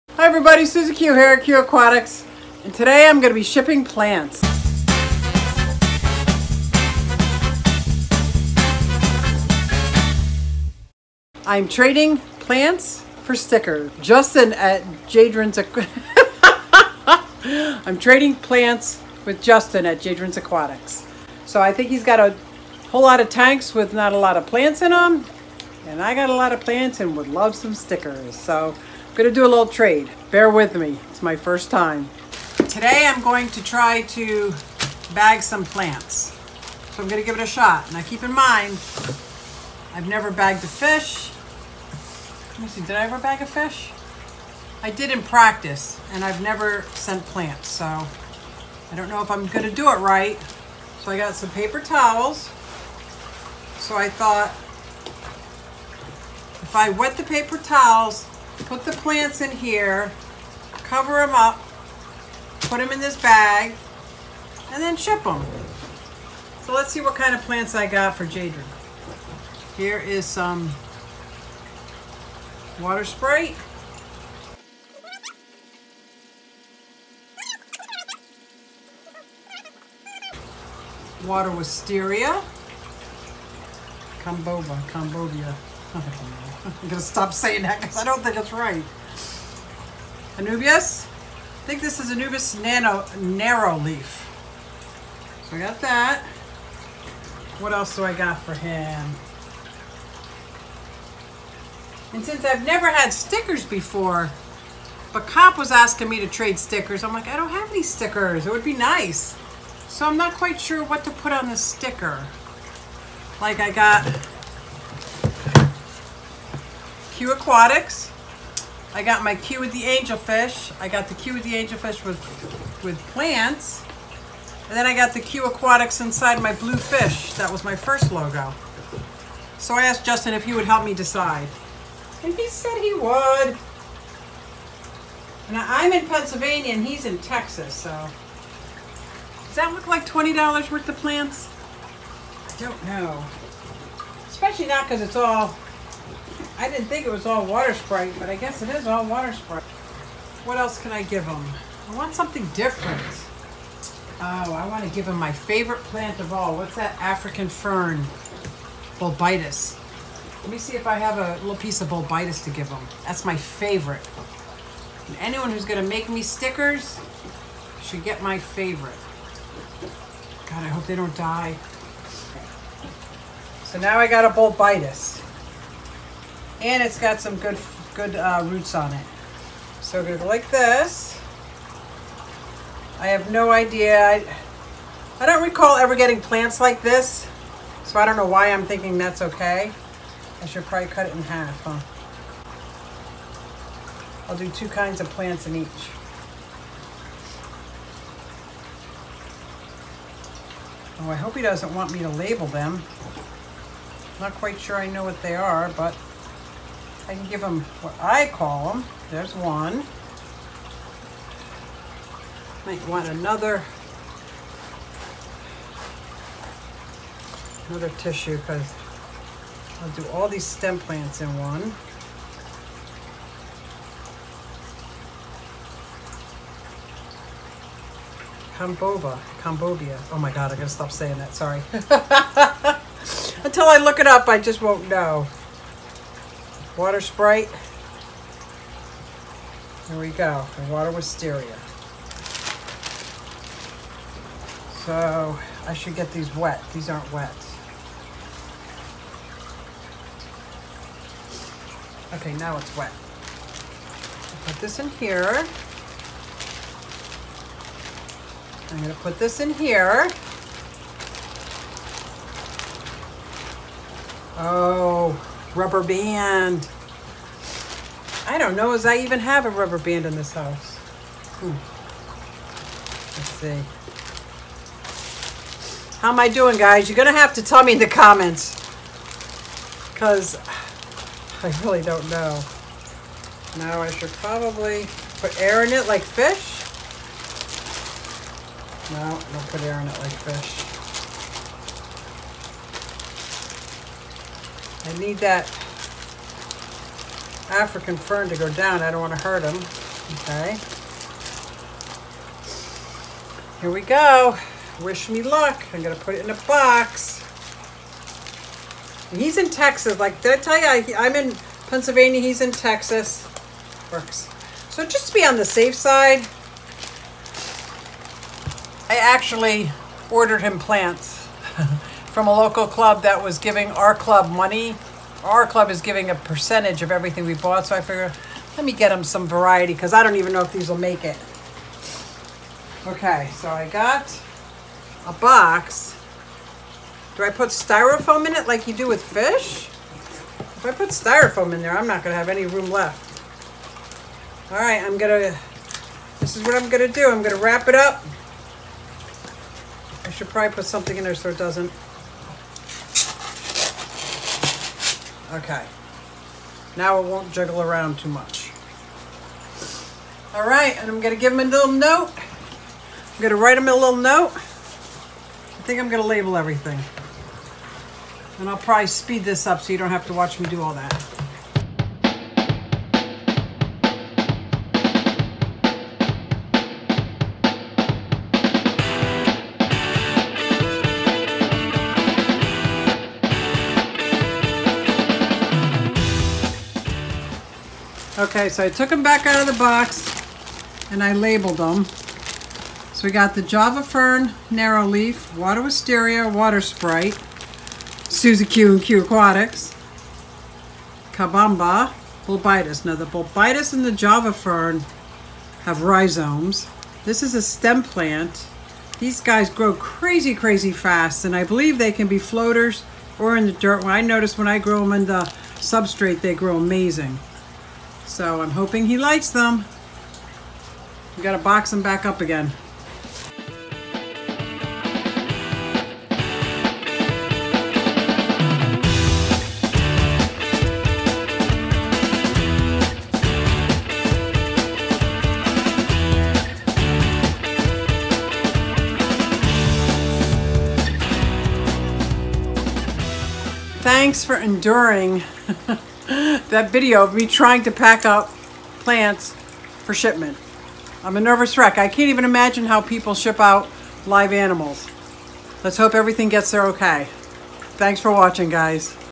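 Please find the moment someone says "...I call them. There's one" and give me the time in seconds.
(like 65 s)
208 s.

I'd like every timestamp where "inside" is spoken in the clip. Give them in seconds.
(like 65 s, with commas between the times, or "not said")
126 s.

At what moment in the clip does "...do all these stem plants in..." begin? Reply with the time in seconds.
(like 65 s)
219 s.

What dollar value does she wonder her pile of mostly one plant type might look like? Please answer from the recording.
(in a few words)
$20.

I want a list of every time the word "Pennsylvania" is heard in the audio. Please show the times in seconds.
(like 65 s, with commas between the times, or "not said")
136 s, 311 s.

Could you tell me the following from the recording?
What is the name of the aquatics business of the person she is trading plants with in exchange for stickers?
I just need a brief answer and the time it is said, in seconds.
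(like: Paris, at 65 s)
Jadren's Aquatics, at 20 s.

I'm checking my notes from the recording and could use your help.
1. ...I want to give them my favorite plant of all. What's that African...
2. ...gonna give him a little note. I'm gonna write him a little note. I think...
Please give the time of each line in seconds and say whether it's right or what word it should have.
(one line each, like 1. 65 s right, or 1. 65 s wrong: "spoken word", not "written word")
1. 154 s right
2. 360 s right.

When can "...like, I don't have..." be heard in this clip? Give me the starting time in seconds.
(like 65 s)
107 s.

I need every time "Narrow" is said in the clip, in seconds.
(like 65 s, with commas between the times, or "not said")
93 s, 394 s.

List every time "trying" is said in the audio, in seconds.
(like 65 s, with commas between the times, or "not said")
447 s.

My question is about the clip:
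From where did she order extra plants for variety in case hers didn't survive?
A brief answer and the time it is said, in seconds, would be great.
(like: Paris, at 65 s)
A local club, at 322 s.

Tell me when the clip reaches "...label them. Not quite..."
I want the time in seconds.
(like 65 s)
202 s.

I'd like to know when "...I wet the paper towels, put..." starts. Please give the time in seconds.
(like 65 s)
56 s.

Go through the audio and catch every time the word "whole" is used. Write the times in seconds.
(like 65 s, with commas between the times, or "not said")
22 s.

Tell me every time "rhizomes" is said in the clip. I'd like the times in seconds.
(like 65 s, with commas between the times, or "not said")
405 s.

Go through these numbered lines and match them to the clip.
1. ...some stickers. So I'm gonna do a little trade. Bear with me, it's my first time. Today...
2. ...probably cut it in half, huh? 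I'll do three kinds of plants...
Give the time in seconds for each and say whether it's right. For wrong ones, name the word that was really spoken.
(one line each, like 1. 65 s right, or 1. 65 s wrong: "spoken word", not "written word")
1. 27 s right
2. 190 s wrong: "two", not "three".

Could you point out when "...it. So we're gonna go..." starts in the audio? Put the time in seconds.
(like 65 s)
178 s.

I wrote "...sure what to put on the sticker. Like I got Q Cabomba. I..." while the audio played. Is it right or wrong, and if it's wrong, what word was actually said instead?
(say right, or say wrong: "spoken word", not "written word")
wrong: "Aquatics", not "Cabomba".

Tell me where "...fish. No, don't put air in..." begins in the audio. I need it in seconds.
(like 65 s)
286 s.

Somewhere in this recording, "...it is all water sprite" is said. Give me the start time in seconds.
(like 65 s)
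148 s.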